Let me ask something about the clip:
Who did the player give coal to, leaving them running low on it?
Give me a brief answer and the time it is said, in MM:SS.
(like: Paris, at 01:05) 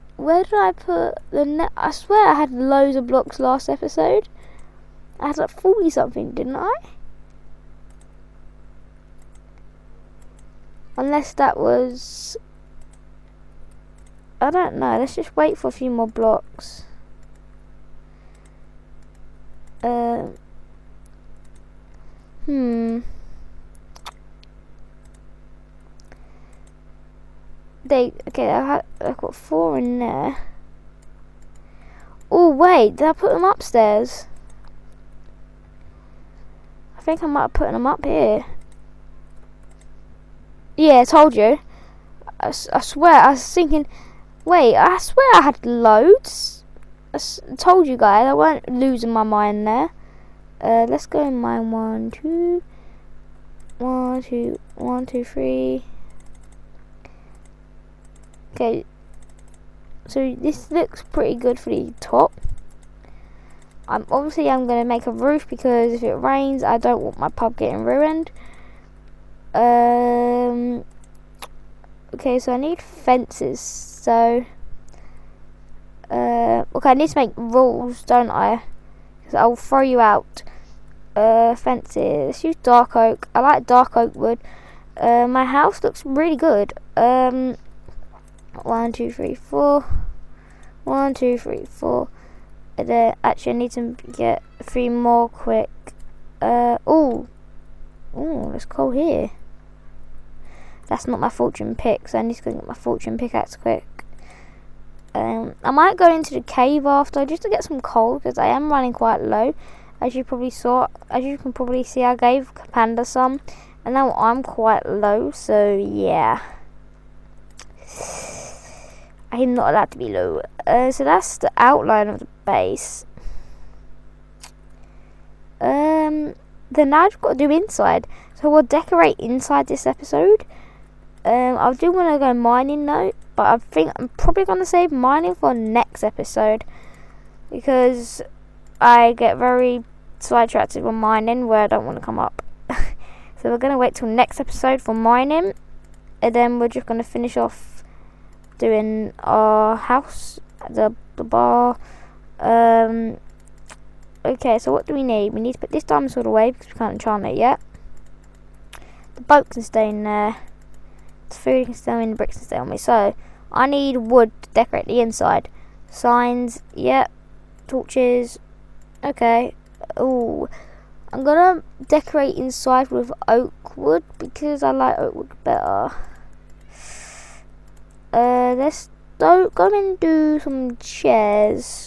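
Panda, at 01:52.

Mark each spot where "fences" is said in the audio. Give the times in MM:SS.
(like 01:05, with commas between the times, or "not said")
01:12, 01:21.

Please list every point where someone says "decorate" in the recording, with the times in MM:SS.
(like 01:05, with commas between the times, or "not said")
02:08, 02:44, 02:51.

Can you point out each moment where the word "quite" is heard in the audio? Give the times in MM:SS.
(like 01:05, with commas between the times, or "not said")
01:48, 01:54.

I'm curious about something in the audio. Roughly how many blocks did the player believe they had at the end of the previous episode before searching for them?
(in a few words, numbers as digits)
40 something.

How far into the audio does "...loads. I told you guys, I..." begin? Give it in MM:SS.
00:45.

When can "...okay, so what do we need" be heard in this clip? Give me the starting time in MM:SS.
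02:34.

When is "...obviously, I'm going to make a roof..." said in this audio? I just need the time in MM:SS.
01:04.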